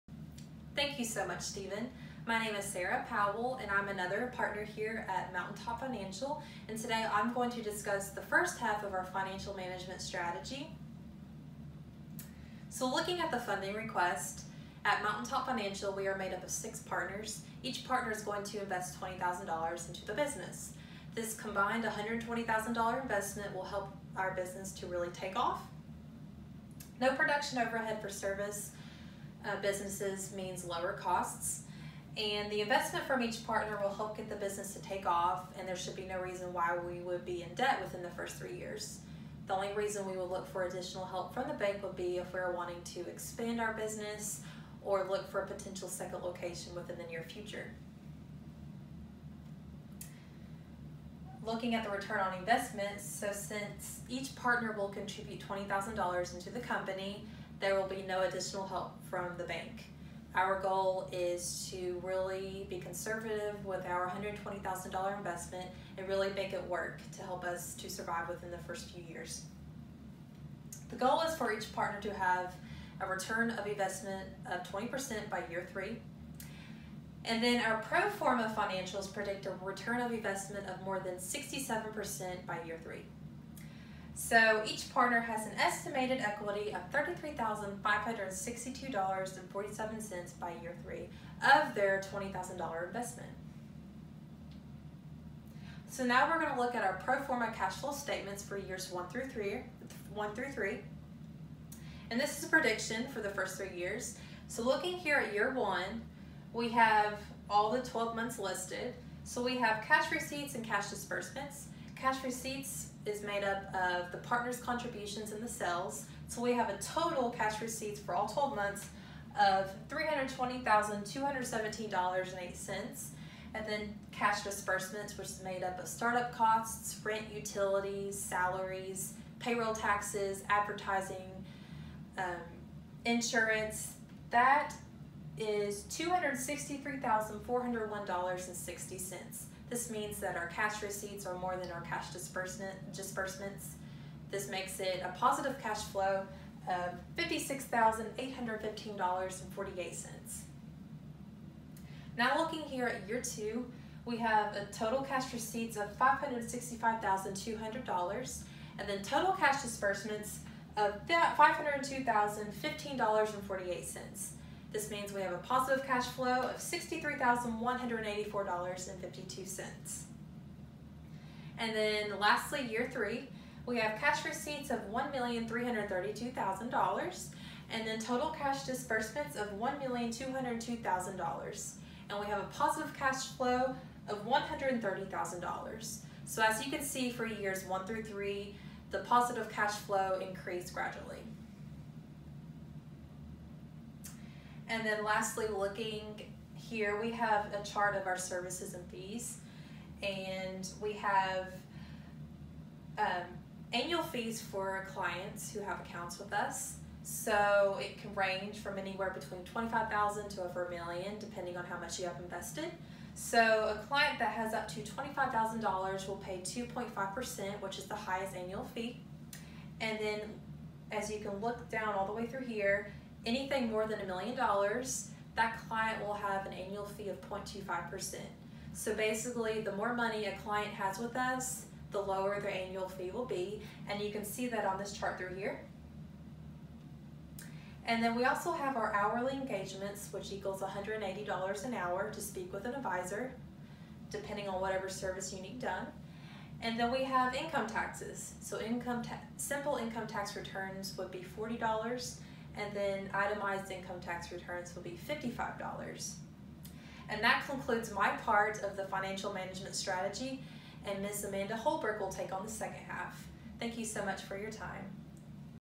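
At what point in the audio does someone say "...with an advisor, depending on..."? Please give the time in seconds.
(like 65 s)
242 s.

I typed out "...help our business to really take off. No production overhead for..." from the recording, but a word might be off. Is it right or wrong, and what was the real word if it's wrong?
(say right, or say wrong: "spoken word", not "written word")
right.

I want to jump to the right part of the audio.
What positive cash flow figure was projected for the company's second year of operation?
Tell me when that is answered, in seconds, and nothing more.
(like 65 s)
166 s.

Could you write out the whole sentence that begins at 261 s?
Amanda Holbrook will take on the second half.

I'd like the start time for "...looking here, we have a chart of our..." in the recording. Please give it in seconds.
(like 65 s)
195 s.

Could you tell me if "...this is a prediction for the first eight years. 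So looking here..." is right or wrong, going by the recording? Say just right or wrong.
wrong.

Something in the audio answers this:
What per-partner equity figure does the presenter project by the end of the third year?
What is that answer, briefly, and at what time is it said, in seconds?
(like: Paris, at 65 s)
$33,562.47, at 86 s.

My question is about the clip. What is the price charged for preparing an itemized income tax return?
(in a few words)
$55.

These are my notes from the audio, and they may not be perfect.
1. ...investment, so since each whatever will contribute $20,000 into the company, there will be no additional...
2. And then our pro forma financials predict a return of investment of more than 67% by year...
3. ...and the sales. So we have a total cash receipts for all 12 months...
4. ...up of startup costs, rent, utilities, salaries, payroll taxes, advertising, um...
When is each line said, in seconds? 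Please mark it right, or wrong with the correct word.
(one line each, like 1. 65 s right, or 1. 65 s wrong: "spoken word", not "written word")
1. 52 s wrong: "partner", not "whatever"
2. 77 s right
3. 115 s right
4. 125 s right.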